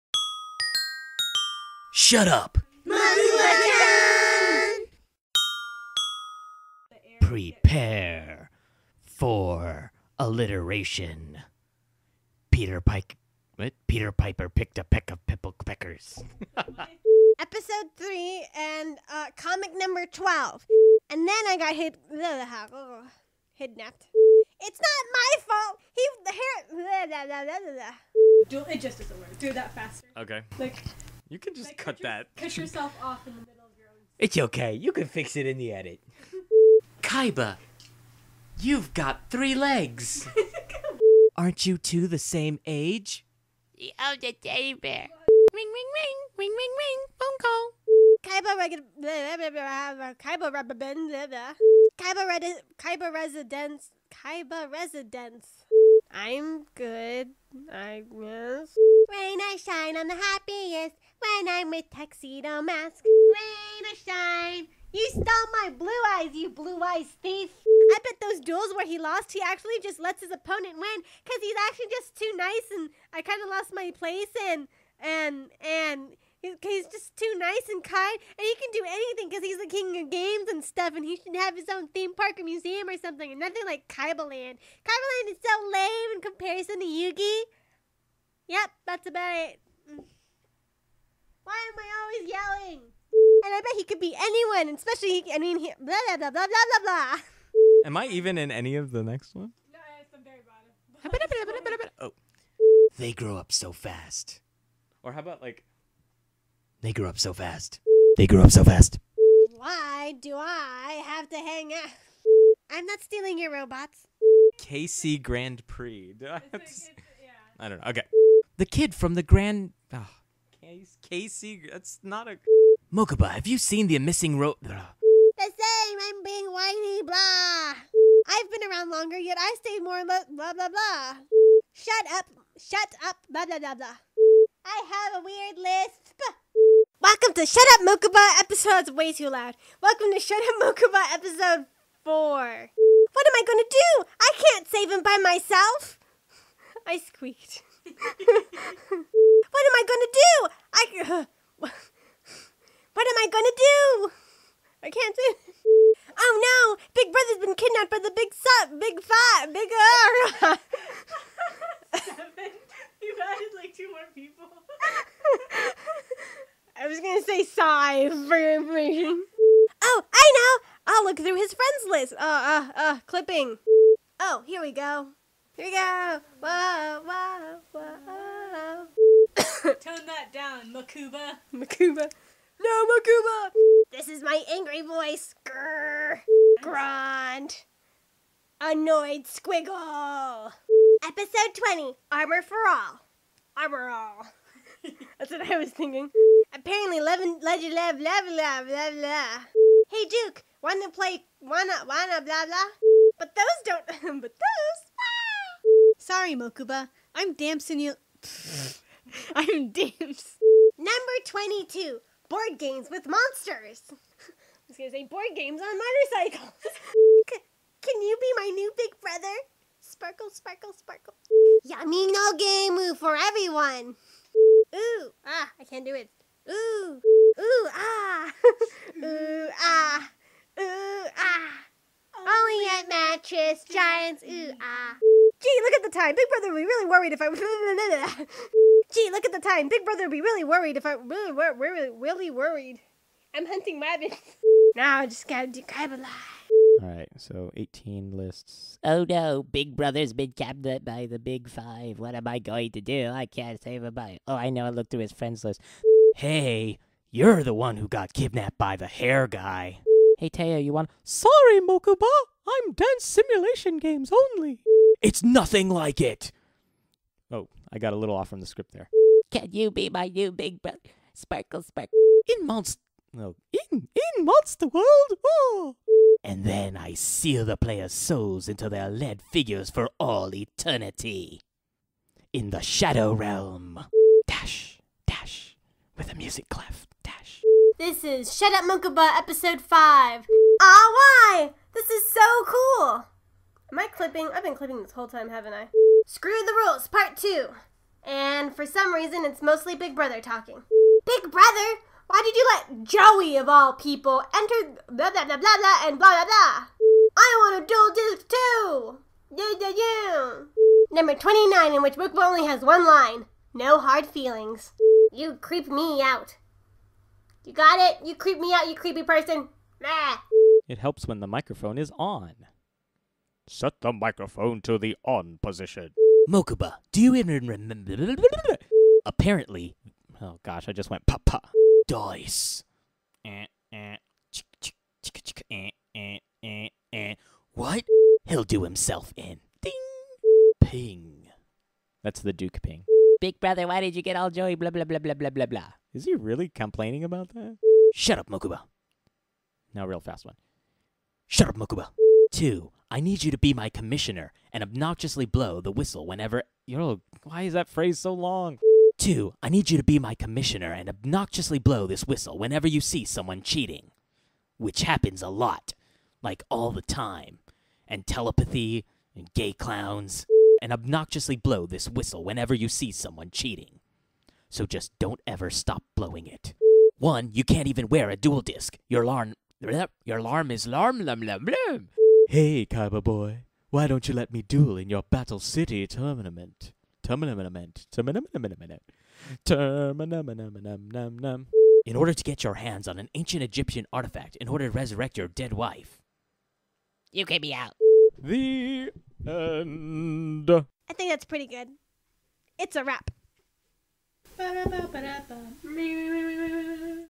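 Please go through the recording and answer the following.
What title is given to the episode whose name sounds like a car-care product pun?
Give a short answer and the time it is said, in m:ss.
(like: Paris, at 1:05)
Armor for All, at 3:12.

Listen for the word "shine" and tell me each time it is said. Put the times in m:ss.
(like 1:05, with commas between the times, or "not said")
0:59, 1:03.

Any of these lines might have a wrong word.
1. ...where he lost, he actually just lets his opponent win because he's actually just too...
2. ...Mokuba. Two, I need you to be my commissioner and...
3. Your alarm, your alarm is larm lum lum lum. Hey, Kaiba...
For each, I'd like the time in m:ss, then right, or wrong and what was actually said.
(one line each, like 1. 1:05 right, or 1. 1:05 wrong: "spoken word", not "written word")
1. 1:08 right
2. 5:51 right
3. 6:18 right.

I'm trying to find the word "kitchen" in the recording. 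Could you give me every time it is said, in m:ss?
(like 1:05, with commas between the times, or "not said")
not said.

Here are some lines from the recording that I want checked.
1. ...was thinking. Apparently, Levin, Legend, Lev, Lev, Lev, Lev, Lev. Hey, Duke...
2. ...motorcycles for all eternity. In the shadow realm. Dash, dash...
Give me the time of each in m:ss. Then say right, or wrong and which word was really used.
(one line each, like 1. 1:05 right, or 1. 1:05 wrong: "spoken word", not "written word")
1. 3:15 right
2. 4:39 wrong: "figures", not "motorcycles".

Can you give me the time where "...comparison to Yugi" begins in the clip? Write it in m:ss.
1:26.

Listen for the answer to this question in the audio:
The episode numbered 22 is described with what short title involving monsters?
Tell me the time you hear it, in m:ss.
3:32.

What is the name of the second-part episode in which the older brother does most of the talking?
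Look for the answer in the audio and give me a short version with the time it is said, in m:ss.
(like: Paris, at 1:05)
Screw the Rules, Part 2, at 4:56.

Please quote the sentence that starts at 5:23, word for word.
Set the microphone to the on position.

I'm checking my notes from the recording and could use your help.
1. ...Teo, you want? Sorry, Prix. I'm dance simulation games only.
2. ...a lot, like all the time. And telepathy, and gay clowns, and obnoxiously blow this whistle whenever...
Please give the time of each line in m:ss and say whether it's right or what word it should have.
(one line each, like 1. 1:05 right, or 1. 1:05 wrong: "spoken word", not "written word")
1. 4:20 wrong: "Mokuba", not "Prix"
2. 6:05 right.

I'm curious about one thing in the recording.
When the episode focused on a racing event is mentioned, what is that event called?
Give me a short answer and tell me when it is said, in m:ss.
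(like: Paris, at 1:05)
KC Grand Prix, at 1:54.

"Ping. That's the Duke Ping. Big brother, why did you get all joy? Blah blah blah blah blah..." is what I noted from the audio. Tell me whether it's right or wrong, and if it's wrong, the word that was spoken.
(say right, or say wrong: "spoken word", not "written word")
right.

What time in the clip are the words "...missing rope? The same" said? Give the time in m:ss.
2:03.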